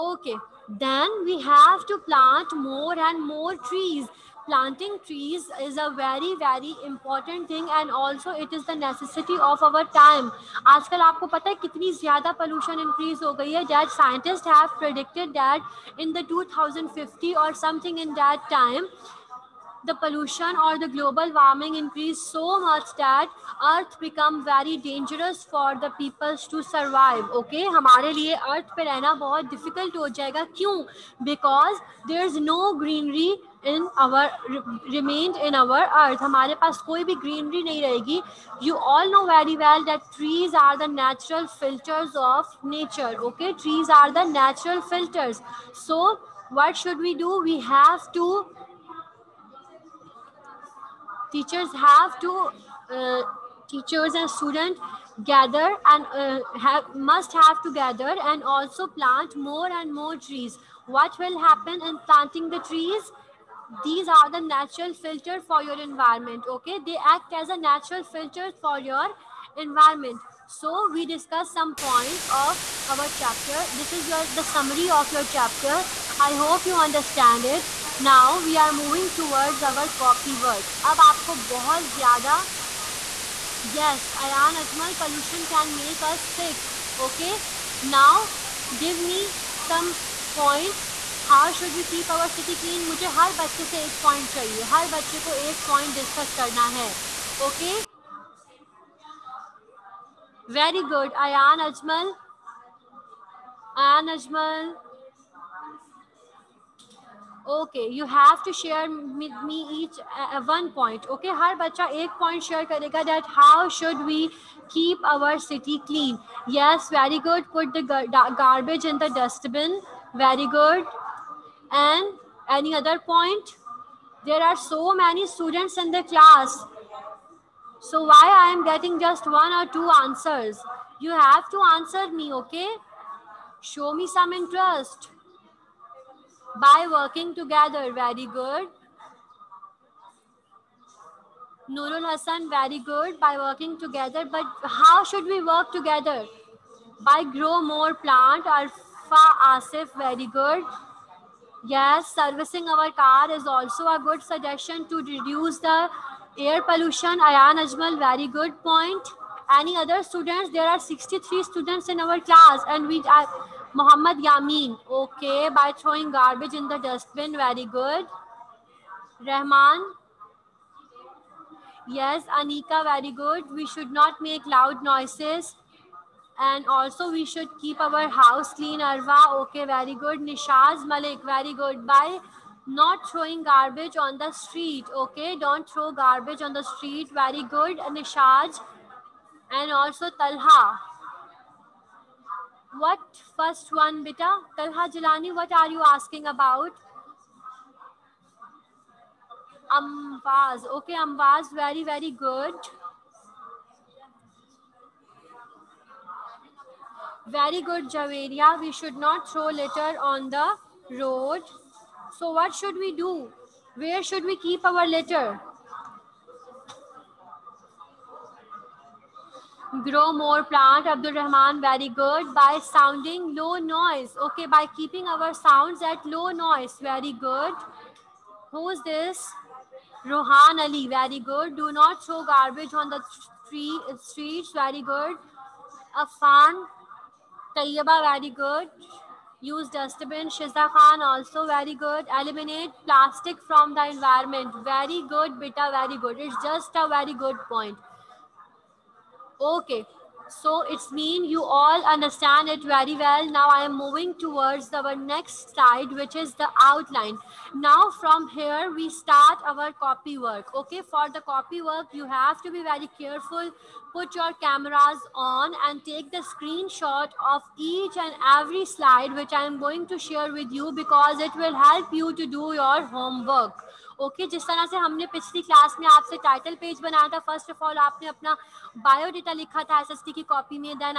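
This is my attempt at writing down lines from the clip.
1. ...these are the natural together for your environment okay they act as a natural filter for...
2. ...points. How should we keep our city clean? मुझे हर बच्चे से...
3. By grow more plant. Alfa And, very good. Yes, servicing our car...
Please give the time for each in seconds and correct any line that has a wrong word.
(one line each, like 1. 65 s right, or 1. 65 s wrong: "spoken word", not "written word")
1. 63 s wrong: "filter", not "together"
2. 90 s right
3. 147 s wrong: "Asif", not "And".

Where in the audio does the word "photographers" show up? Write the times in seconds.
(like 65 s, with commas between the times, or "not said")
not said.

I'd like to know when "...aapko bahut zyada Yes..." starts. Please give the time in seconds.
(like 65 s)
81 s.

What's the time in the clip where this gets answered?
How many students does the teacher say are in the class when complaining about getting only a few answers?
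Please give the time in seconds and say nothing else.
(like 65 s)
160 s.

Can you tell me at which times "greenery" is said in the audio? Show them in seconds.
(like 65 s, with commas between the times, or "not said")
32 s, 37 s.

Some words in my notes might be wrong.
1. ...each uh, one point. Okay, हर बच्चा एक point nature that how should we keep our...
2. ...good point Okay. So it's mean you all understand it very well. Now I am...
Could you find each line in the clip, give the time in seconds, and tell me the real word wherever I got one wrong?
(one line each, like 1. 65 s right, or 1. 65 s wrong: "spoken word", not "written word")
1. 109 s wrong: "share", not "nature"
2. 247 s right.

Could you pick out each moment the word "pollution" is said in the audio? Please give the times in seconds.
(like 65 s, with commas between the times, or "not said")
12 s, 19 s, 85 s, 156 s.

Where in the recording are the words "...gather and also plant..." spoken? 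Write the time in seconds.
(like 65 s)
57 s.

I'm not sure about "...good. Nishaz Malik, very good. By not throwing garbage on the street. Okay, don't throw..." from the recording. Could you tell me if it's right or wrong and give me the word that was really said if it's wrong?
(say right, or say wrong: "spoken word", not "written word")
right.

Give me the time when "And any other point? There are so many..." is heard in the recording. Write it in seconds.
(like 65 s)
121 s.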